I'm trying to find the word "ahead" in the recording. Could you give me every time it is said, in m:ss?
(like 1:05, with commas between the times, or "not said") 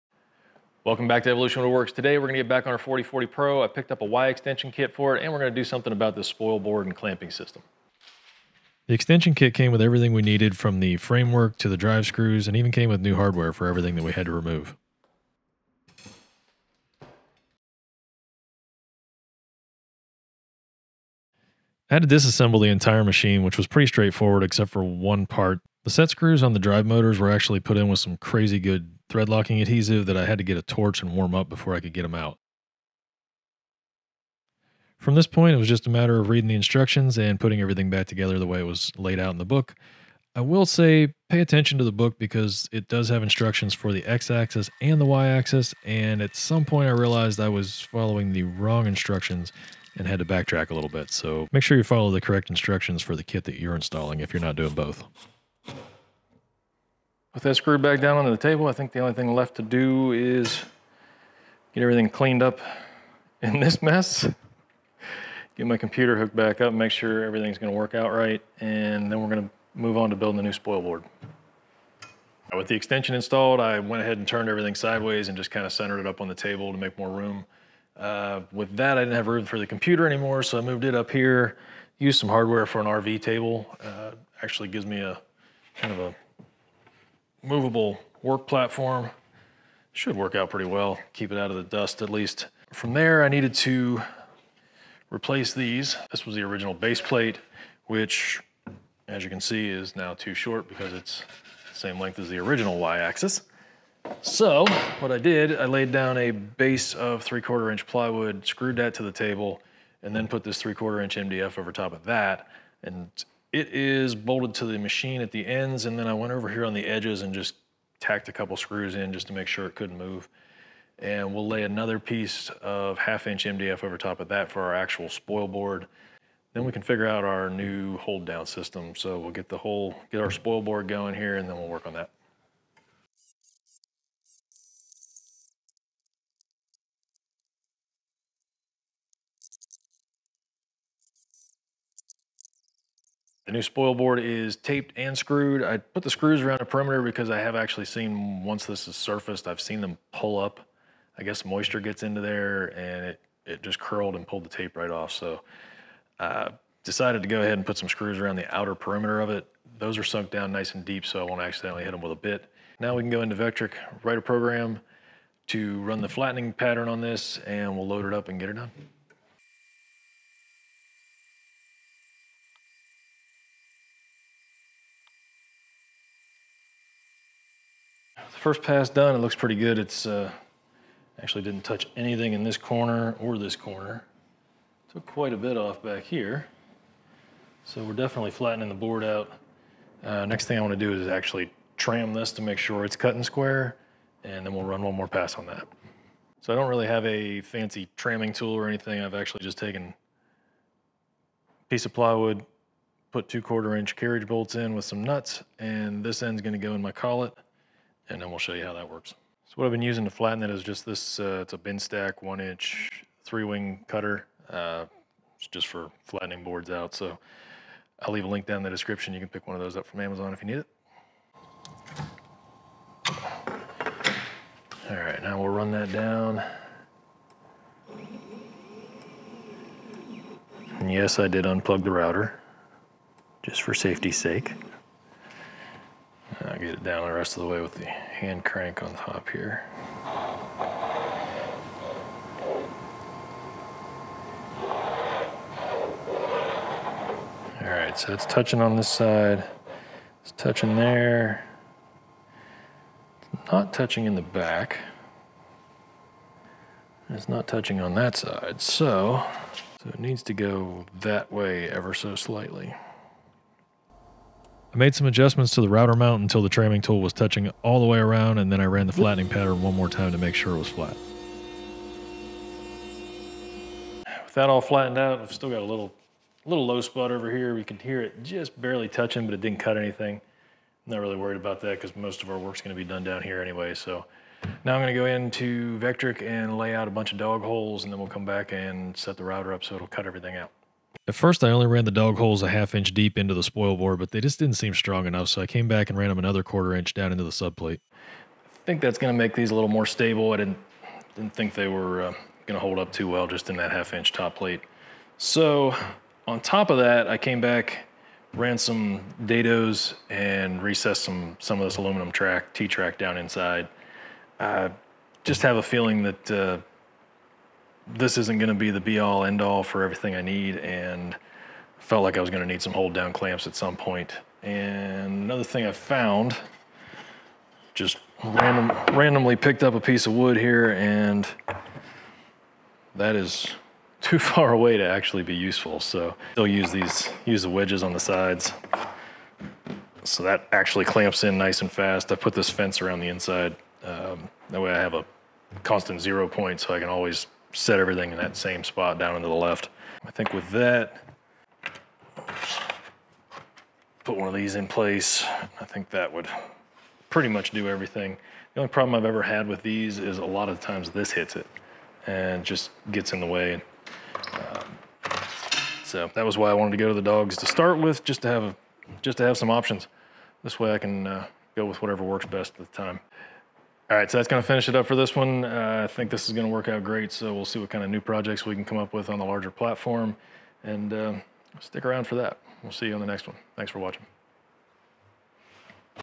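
1:14, 2:37.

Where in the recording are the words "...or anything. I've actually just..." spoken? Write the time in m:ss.
3:18.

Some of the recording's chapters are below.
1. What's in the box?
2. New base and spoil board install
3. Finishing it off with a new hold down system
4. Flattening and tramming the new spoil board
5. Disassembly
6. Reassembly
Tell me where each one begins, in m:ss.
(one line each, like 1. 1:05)
1. 0:10
2. 1:12
3. 4:50
4. 2:48
5. 0:20
6. 0:30.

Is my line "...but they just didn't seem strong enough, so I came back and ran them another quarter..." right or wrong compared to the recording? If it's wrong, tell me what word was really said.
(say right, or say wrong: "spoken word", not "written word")
right.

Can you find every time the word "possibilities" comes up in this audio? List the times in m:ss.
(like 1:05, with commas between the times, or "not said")
not said.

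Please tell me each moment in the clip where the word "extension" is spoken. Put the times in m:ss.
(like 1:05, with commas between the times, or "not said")
0:04, 0:08, 1:12.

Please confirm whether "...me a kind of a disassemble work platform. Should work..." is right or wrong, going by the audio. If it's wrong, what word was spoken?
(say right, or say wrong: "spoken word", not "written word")
wrong: "movable", not "disassemble".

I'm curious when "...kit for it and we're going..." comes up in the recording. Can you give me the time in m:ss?
0:04.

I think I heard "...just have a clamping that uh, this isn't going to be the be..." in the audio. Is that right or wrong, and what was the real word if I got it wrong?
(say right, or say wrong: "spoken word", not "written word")
wrong: "feeling", not "clamping".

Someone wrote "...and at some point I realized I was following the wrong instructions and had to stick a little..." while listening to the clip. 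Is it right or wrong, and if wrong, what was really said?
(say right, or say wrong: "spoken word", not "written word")
wrong: "backtrack", not "stick".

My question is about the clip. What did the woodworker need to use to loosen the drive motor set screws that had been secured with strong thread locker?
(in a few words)
a torch.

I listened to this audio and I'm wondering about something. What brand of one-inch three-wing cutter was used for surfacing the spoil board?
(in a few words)
Binstak.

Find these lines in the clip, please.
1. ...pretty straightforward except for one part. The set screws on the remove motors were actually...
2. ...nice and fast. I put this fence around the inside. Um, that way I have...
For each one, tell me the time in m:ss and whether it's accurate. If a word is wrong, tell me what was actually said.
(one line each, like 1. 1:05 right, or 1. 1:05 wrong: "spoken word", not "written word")
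1. 0:23 wrong: "drive", not "remove"
2. 5:41 right.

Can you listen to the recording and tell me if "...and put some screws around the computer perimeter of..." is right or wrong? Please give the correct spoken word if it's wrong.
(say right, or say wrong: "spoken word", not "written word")
wrong: "outer", not "computer".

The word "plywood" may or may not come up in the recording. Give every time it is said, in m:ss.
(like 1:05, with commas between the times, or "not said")
1:47, 3:21.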